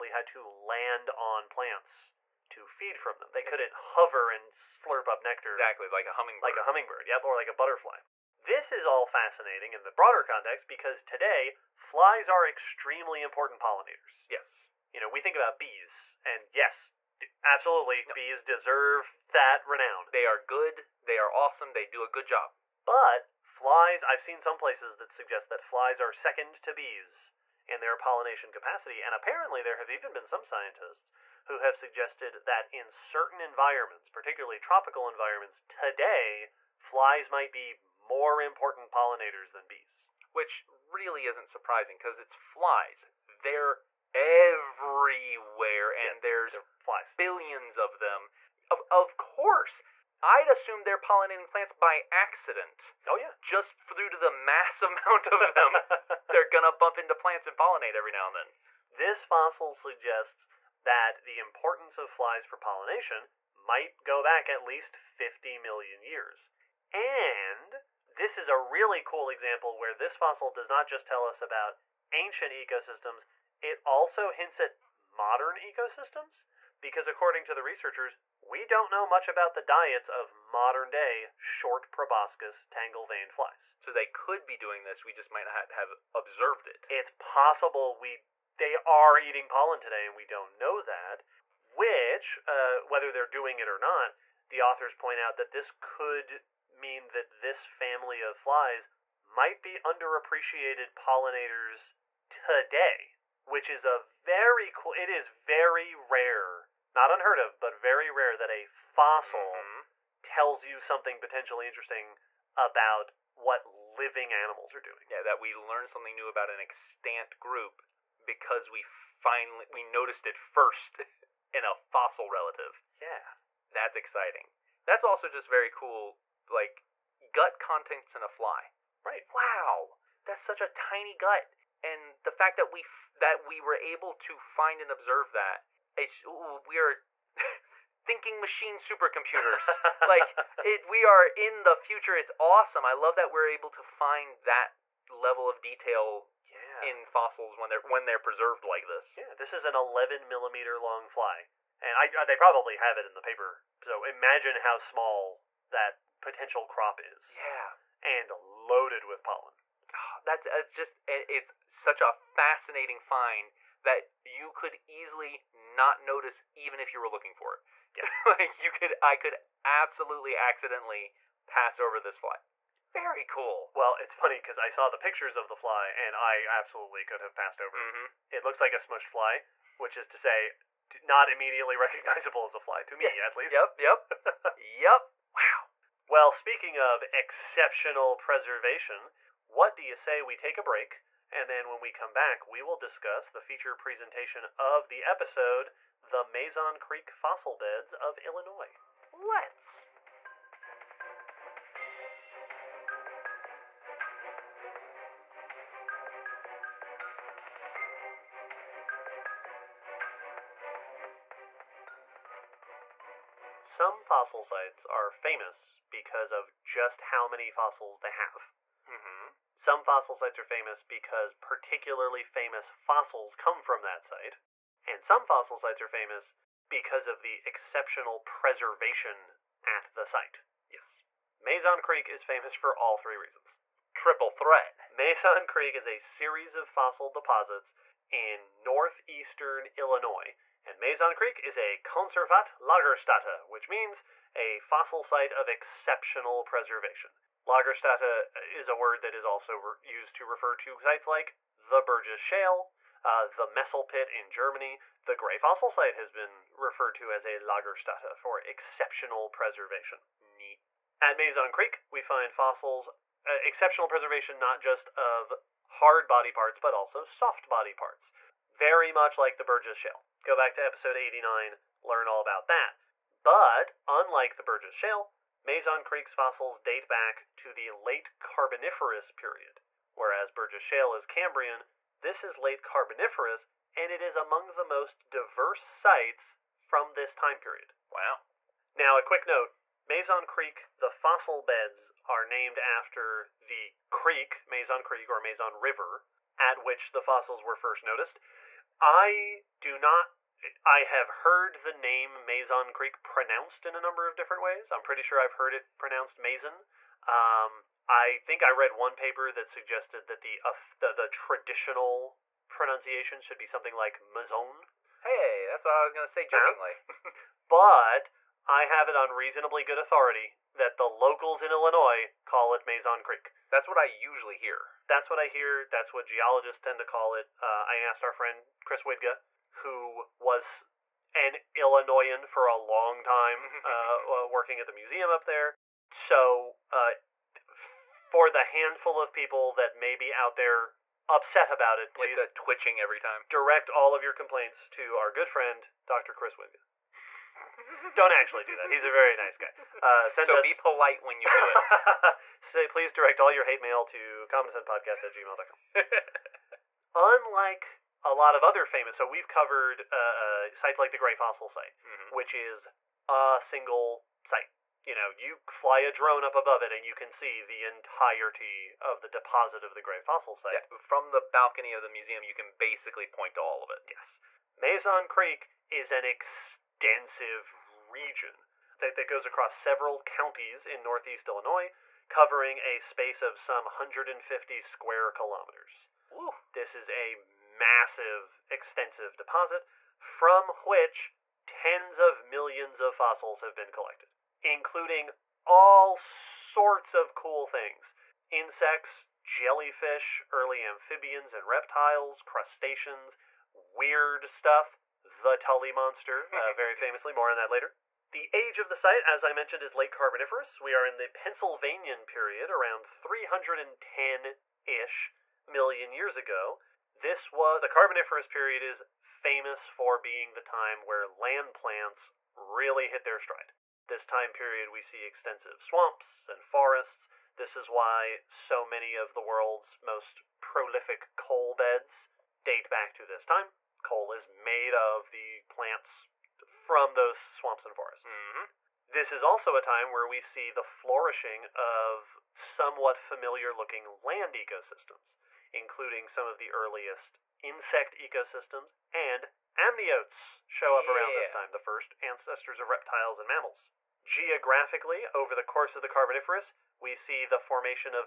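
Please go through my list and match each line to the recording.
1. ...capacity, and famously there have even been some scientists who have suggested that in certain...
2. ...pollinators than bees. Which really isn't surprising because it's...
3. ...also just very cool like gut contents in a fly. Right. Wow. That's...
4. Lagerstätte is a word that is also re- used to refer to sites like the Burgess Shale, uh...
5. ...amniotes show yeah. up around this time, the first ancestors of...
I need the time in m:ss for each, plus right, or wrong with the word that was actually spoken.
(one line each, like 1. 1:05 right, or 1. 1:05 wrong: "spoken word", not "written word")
1. 0:28 wrong: "apparently", not "famously"
2. 0:38 right
3. 2:05 right
4. 4:07 right
5. 7:29 right.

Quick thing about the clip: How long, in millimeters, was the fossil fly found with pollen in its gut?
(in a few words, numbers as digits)
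11 millimeters.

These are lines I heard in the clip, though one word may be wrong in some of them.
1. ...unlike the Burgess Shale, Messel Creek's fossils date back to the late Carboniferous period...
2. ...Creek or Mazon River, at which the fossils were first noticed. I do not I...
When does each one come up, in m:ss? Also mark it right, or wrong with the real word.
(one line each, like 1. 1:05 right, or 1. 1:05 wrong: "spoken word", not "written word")
1. 4:33 wrong: "Mazon", not "Messel"
2. 4:54 right.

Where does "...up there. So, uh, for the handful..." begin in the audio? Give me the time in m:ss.
5:35.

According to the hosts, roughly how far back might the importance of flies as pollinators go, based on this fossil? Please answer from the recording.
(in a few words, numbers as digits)
50 million years.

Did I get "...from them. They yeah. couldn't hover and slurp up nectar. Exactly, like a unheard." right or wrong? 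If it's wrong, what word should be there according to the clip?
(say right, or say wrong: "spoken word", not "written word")
wrong: "hummingbird", not "unheard".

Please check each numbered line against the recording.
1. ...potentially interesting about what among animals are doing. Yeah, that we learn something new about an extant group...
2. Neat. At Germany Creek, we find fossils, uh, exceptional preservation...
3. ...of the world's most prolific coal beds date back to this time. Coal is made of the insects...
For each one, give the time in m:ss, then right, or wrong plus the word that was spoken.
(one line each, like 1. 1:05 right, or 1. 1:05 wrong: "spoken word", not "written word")
1. 1:51 wrong: "living", not "among"
2. 4:20 wrong: "Mazon", not "Germany"
3. 7:08 wrong: "plants", not "insects".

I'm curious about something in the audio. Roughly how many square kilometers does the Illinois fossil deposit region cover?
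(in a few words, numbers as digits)
150 square kilometers.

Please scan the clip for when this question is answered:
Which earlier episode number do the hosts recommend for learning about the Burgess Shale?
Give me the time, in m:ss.
4:30.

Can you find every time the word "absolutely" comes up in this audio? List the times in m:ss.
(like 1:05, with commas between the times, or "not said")
0:17, 2:49, 2:56.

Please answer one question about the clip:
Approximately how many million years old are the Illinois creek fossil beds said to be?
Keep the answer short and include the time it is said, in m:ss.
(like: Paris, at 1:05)
310 million years, at 6:52.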